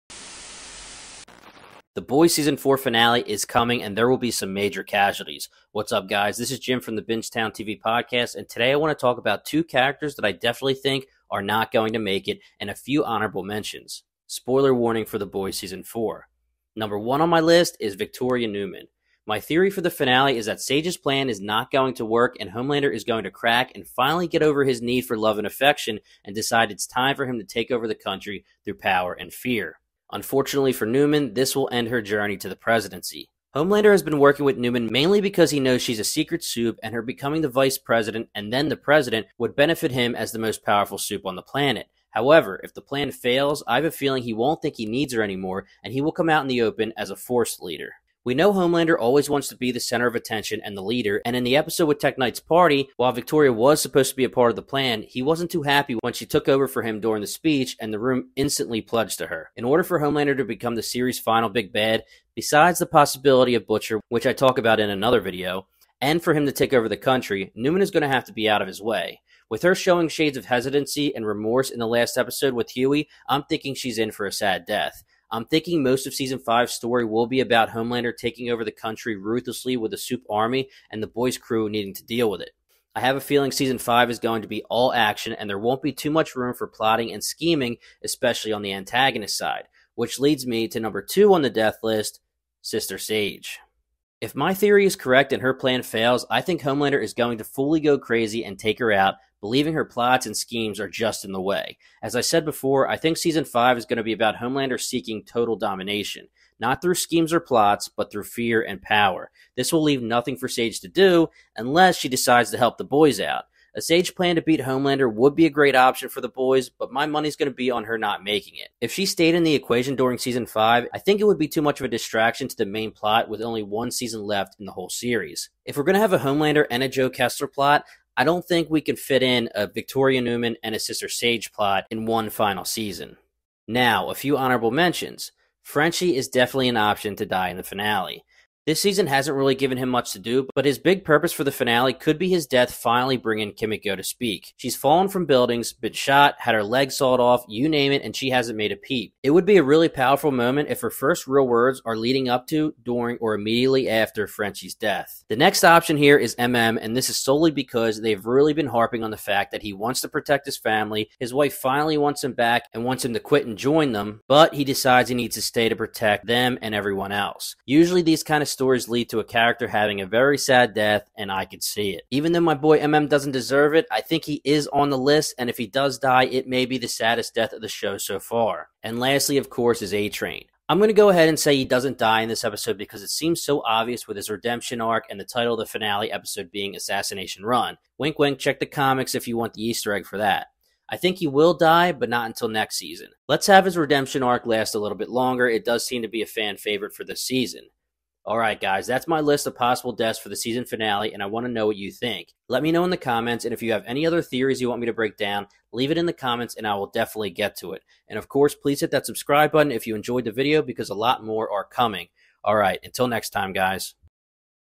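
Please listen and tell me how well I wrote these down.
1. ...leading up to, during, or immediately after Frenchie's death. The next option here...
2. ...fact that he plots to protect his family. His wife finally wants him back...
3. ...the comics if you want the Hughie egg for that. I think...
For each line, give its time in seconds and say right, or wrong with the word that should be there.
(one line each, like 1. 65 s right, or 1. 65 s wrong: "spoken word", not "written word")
1. 151 s right
2. 159 s wrong: "wants", not "plots"
3. 188 s wrong: "Easter", not "Hughie".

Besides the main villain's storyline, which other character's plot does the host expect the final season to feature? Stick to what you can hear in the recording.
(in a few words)
Joe Kessler.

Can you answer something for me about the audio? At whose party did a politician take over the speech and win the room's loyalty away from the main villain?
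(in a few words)
Tek Knight.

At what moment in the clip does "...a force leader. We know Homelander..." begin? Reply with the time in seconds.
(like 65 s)
47 s.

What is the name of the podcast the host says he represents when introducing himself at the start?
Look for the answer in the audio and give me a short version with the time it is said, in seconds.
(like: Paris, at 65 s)
Bingetown TV, at 7 s.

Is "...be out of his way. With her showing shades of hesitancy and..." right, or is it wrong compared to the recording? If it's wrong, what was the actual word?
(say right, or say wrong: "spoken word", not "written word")
right.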